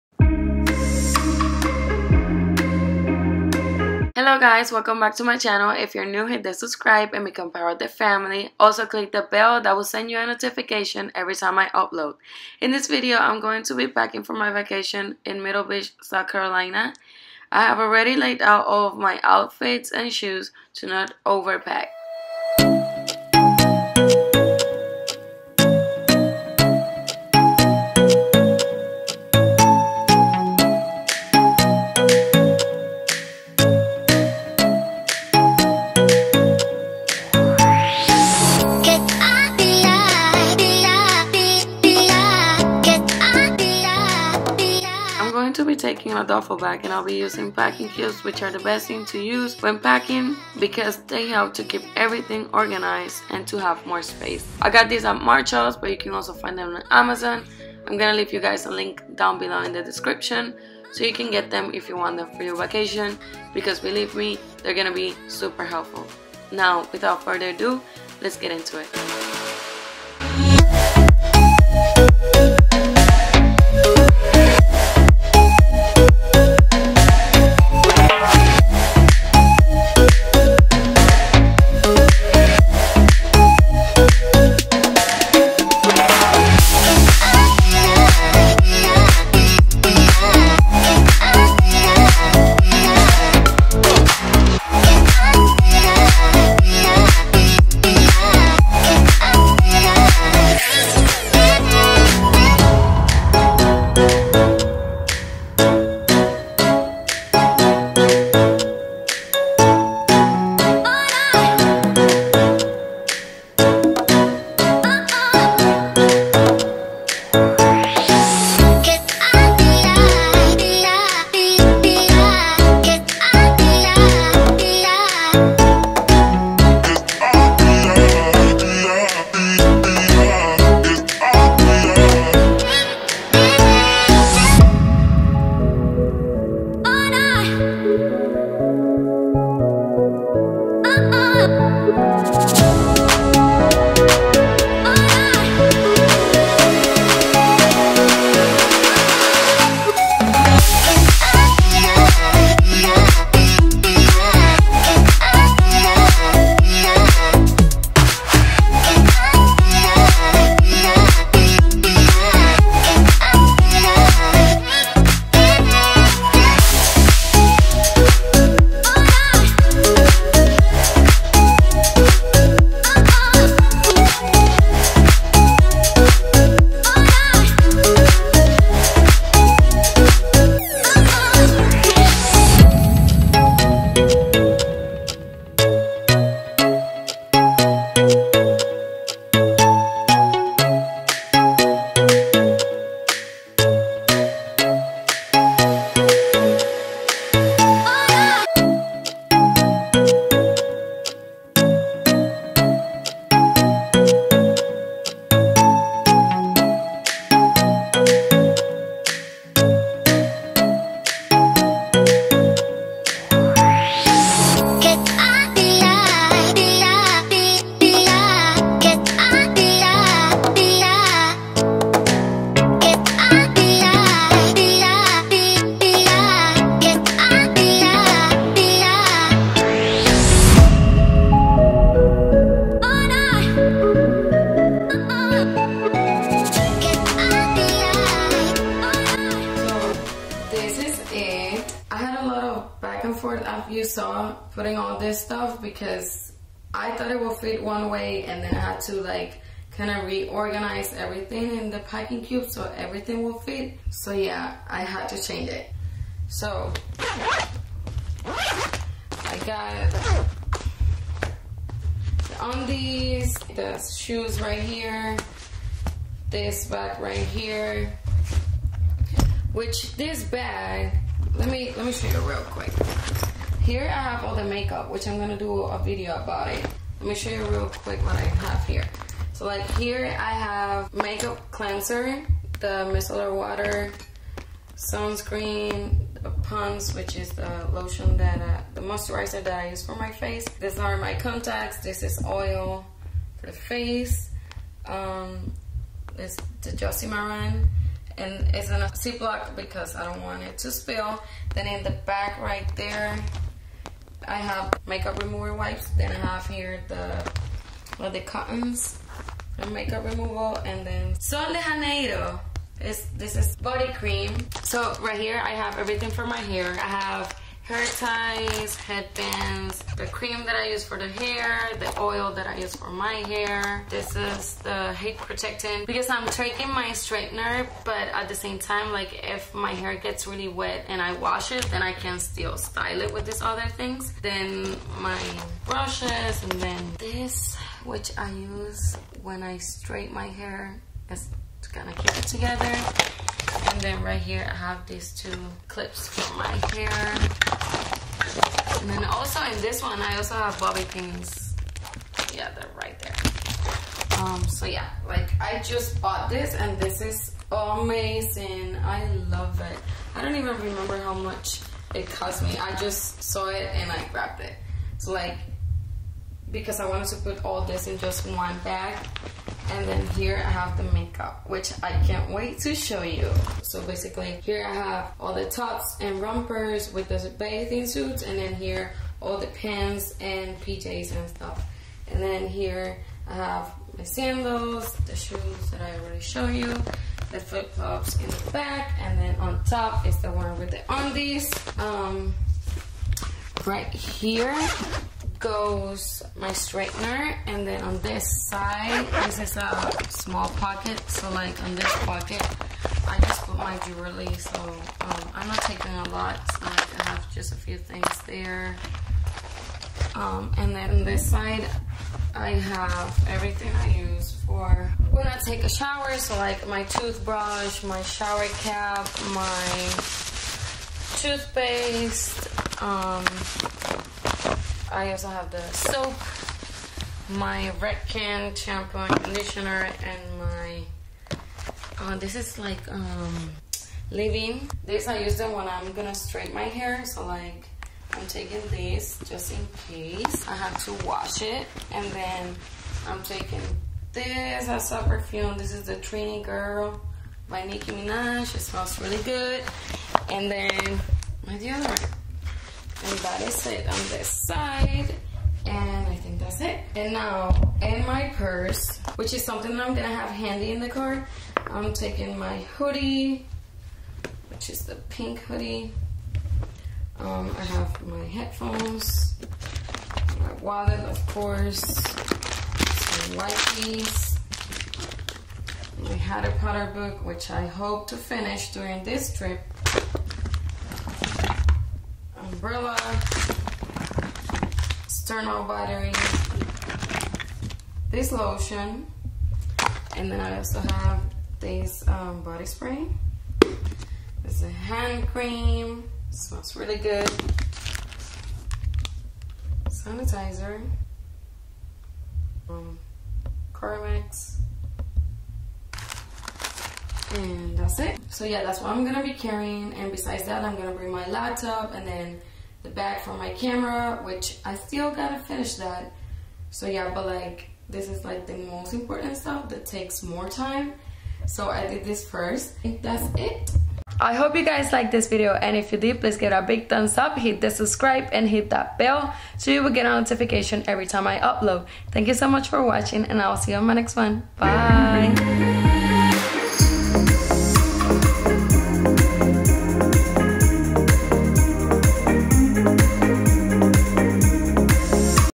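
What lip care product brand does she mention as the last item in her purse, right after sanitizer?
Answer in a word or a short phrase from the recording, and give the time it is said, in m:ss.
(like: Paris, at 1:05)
Carmex, at 8:23.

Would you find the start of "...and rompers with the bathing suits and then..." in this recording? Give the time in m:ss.
6:16.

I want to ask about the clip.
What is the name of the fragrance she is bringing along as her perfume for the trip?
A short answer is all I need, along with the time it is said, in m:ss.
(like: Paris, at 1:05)
Trini Girl, at 7:25.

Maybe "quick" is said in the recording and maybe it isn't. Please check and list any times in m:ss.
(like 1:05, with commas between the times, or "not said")
4:32, 4:37.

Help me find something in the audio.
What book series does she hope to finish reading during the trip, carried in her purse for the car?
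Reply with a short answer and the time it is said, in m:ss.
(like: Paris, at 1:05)
Harry Potter, at 7:56.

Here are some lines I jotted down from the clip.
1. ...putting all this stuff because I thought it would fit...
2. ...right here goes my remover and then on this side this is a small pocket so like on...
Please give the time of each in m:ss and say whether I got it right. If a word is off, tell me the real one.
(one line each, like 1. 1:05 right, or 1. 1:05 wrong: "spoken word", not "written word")
1. 4:04 right
2. 6:33 wrong: "straightener", not "remover".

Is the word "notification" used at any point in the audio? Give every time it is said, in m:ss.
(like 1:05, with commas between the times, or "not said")
0:10, 8:50.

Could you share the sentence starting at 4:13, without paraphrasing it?
So yeah, I had to change it.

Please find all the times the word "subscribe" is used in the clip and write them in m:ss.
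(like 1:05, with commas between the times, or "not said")
0:06, 8:47.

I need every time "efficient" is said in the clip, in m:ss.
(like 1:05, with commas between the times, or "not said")
not said.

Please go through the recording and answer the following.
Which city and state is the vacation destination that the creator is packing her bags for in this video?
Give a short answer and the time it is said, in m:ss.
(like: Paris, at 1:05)
Myrtle Beach, South Carolina, at 0:15.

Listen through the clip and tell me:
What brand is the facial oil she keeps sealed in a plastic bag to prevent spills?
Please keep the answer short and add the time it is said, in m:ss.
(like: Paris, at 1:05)
Josie Maran, at 4:56.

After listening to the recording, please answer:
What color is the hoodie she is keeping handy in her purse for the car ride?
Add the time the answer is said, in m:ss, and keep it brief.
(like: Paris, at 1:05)
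Pink, at 7:45.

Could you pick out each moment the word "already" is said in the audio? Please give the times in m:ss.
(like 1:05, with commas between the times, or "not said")
0:17, 6:25.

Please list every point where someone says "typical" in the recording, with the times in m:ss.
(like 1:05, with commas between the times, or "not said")
not said.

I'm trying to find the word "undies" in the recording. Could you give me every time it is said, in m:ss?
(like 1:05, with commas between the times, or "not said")
4:22, 6:30.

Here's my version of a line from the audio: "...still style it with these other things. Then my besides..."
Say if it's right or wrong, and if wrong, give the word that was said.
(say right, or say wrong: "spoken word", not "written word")
wrong: "brushes", not "besides".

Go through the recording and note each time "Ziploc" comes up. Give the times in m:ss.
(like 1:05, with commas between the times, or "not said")
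4:58.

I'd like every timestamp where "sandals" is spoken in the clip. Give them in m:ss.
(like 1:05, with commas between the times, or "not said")
6:24.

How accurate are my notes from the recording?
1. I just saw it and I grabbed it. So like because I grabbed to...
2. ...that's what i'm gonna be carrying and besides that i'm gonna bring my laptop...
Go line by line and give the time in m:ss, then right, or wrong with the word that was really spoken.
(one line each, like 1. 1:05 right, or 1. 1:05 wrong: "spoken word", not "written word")
1. 6:02 wrong: "wanted", not "grabbed"
2. 8:28 right.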